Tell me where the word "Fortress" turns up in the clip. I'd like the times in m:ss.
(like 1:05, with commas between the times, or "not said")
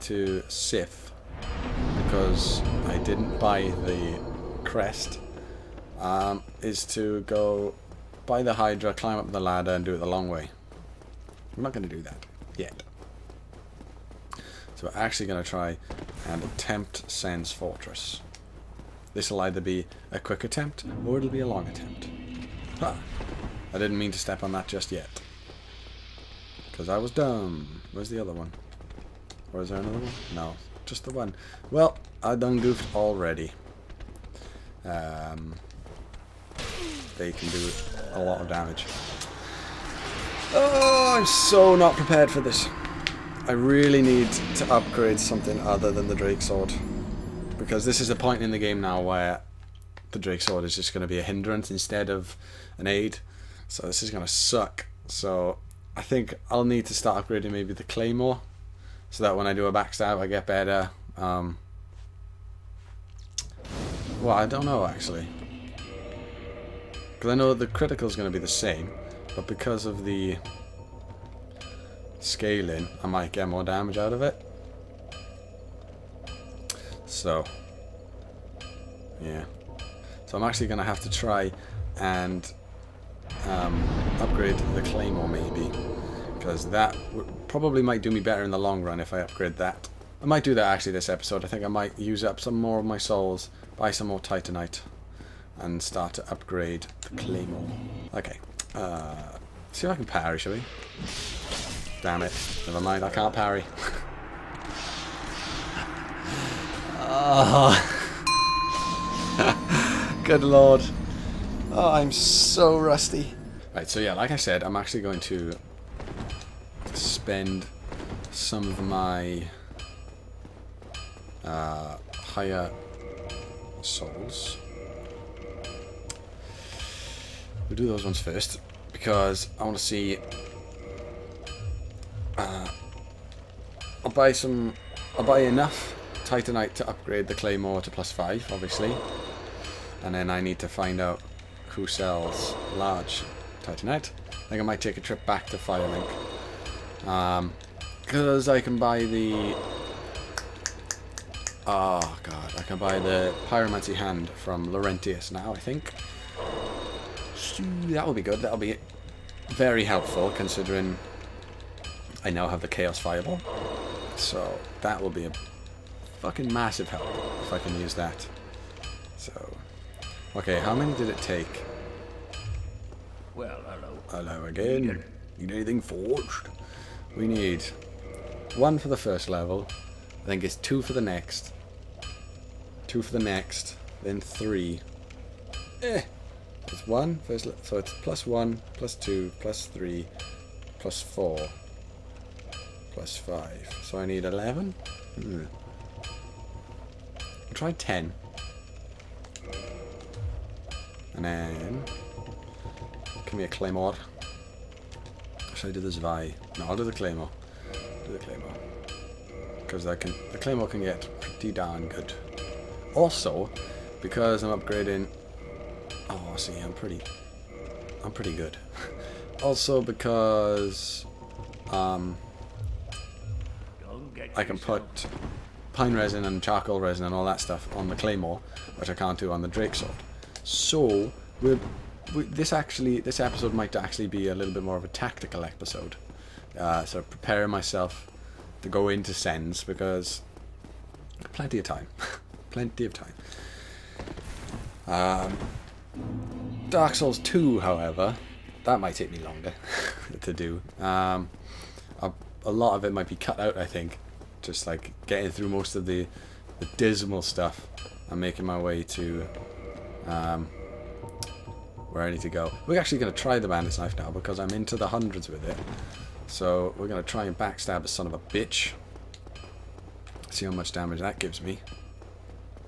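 0:17.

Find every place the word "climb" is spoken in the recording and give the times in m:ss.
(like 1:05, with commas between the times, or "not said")
0:08.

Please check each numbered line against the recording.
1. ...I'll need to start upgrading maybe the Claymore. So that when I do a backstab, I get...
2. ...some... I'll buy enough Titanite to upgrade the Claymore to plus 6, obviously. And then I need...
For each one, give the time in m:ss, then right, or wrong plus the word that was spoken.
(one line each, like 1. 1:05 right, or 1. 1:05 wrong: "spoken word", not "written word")
1. 0:56 right
2. 2:14 wrong: "5", not "6".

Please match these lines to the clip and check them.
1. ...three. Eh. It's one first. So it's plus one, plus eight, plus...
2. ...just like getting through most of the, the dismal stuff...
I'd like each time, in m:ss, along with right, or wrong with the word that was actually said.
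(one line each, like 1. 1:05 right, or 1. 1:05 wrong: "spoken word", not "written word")
1. 3:04 wrong: "two", not "eight"
2. 4:14 right.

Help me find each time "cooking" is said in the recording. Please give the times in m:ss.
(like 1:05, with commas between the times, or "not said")
not said.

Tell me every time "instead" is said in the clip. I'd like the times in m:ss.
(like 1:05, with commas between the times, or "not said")
0:51.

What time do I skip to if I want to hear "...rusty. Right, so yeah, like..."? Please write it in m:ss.
1:52.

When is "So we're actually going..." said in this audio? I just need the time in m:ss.
0:14.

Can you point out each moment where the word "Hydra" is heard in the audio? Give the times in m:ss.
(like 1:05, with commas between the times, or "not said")
0:08.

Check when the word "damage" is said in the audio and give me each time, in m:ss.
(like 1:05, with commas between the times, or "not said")
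0:38, 1:13, 4:30.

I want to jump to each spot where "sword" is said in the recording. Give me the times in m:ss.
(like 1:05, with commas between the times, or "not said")
0:46, 0:50, 3:49.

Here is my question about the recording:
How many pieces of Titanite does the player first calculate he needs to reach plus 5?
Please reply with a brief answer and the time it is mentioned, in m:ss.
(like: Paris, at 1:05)
11, at 3:14.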